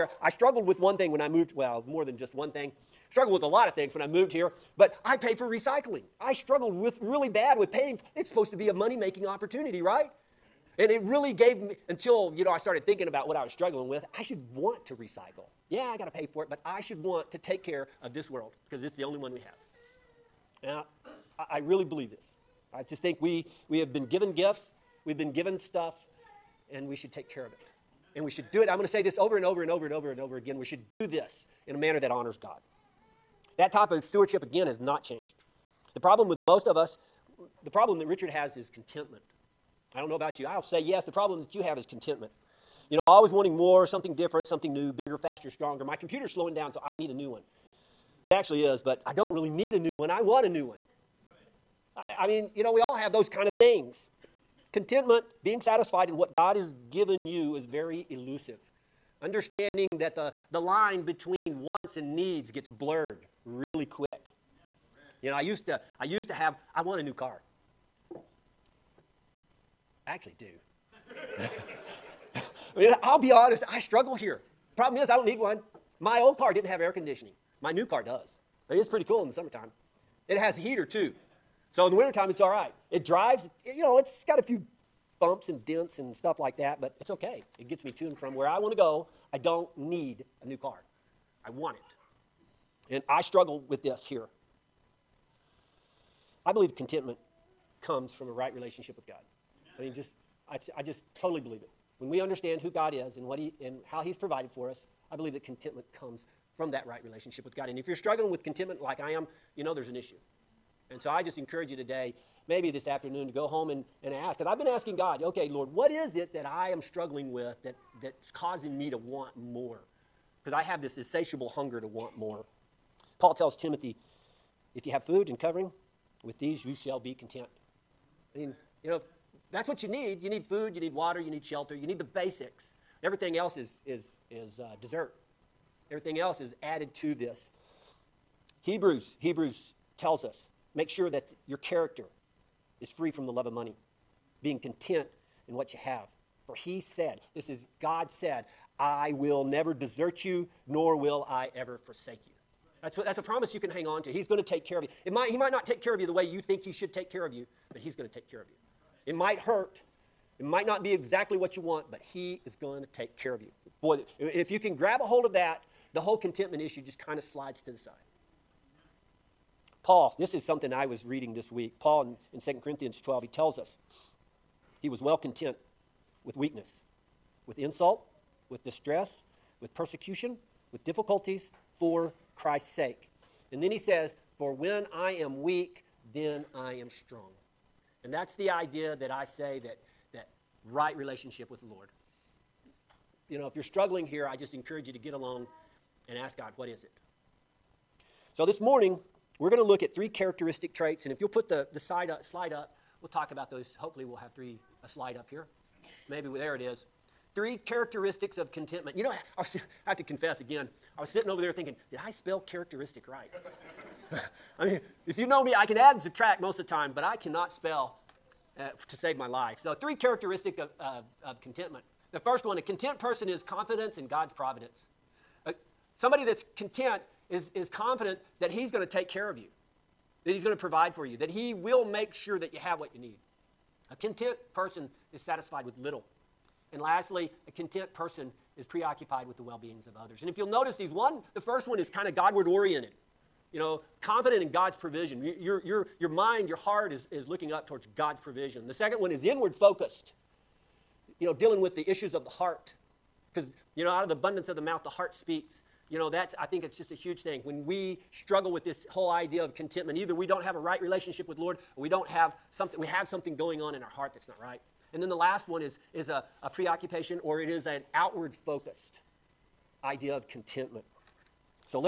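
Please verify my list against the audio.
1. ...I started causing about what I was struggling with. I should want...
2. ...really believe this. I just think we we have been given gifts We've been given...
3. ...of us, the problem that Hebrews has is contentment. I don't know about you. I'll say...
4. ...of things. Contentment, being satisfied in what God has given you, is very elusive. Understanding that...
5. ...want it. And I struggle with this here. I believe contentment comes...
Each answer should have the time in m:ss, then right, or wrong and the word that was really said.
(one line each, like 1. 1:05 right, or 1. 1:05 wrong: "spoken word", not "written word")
1. 0:12 wrong: "thinking", not "causing"
2. 0:21 right
3. 0:36 wrong: "Richard", not "Hebrews"
4. 0:53 right
5. 1:31 right.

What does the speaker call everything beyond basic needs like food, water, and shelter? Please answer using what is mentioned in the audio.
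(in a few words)
Dessert.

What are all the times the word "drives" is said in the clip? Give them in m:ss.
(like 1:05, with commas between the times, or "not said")
1:23.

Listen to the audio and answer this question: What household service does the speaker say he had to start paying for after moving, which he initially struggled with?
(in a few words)
Recycling.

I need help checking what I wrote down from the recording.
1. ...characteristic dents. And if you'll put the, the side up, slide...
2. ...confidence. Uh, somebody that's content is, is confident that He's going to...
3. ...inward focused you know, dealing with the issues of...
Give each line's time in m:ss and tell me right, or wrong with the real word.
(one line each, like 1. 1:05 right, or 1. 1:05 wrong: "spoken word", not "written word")
1. 3:20 wrong: "traits", not "dents"
2. 3:44 wrong: "providence", not "confidence"
3. 4:09 right.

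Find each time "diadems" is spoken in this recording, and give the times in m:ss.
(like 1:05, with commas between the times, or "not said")
not said.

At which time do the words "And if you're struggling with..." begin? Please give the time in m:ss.
1:47.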